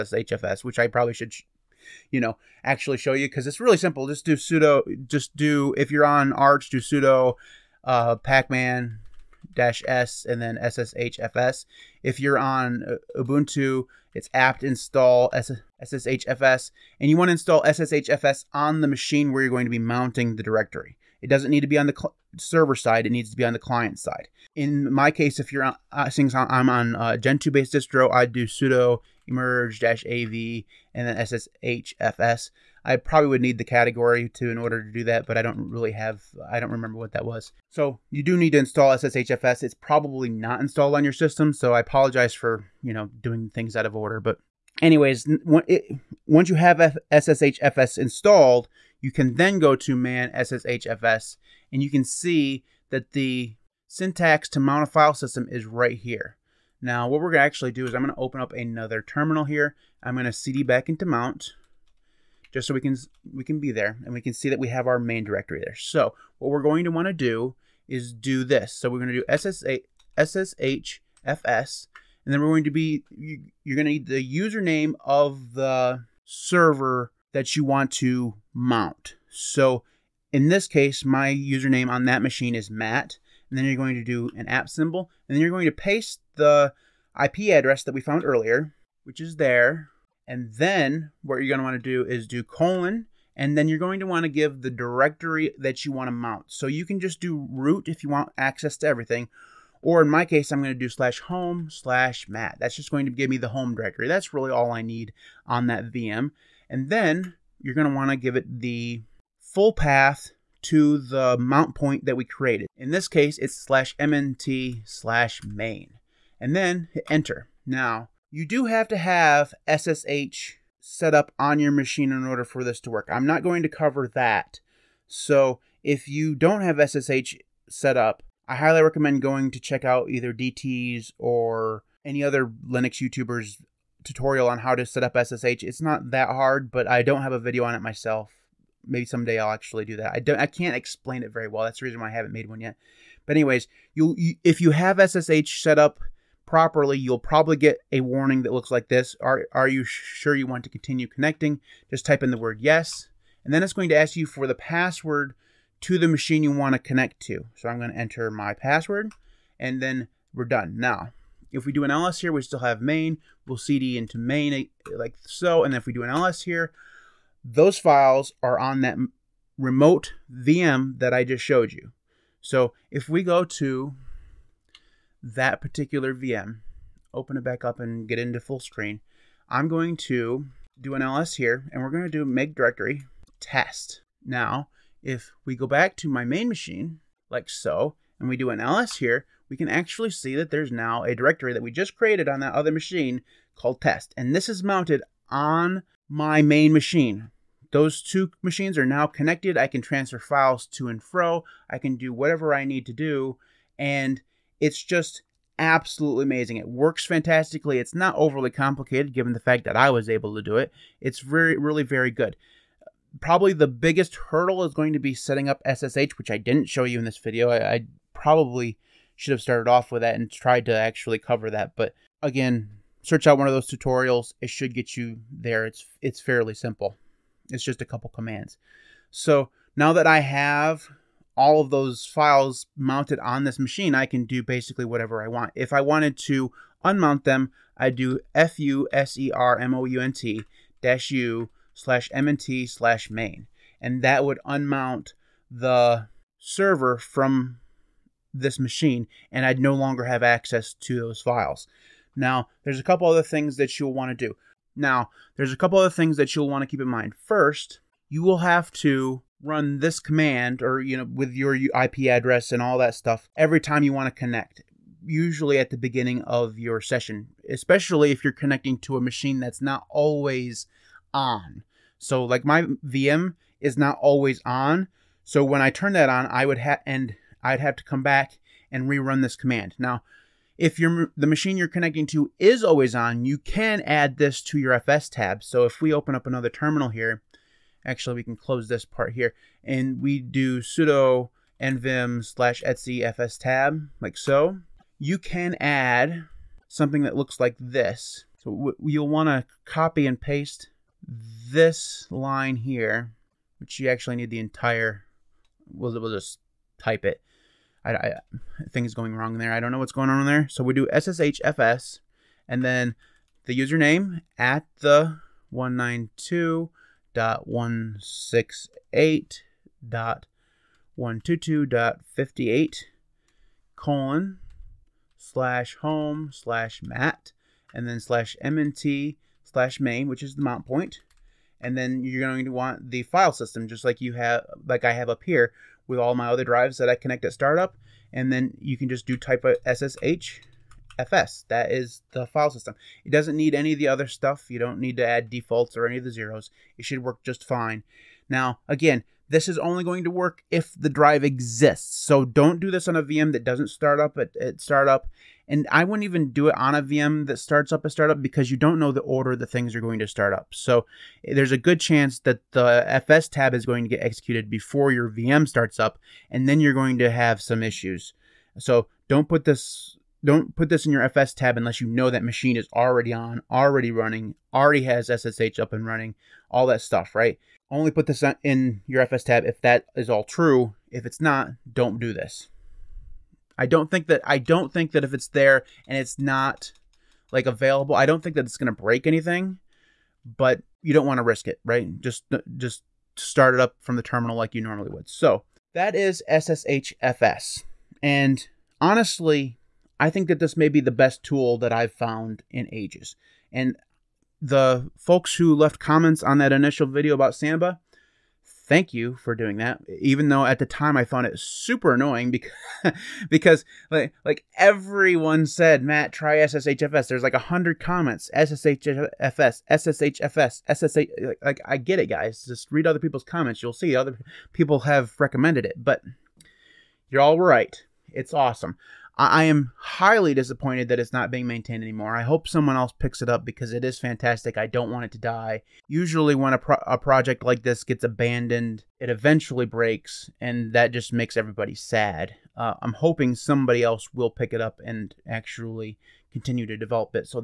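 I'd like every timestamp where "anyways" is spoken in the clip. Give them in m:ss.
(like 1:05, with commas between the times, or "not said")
0:44, 2:23.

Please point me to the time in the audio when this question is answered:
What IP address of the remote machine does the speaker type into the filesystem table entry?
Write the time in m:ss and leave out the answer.
5:15.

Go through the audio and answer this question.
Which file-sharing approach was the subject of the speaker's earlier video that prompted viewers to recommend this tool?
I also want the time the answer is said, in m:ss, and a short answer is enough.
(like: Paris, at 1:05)
Samba, at 6:47.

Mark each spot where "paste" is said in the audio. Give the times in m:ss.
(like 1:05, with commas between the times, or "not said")
1:25, 5:00.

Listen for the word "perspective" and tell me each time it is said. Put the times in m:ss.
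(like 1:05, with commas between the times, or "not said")
not said.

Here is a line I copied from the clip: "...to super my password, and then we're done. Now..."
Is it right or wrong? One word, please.
wrong.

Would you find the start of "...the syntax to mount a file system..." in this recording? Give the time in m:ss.
0:53.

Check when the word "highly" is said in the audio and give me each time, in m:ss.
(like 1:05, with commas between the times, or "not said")
2:08, 7:09.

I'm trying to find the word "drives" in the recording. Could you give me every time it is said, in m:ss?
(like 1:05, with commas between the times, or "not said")
5:36, 5:50.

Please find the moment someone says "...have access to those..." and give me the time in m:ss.
4:10.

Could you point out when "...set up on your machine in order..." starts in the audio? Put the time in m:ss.
2:00.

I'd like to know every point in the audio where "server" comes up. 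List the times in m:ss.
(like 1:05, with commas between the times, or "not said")
0:22, 1:16, 4:06.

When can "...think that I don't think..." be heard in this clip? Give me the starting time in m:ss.
6:23.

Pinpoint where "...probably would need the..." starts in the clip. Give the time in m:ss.
0:32.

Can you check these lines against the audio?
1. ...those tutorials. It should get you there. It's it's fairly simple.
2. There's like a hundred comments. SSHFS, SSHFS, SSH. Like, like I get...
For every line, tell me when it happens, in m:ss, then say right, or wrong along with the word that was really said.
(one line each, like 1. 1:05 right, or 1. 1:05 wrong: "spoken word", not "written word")
1. 3:43 right
2. 6:57 right.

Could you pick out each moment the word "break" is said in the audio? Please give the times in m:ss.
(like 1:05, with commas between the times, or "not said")
6:28, 7:19.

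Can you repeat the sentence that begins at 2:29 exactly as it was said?
Are Are you sure you want to continue connecting?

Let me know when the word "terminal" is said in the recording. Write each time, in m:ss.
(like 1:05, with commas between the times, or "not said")
0:59, 4:46, 6:34.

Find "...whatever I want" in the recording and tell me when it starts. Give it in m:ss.
3:54.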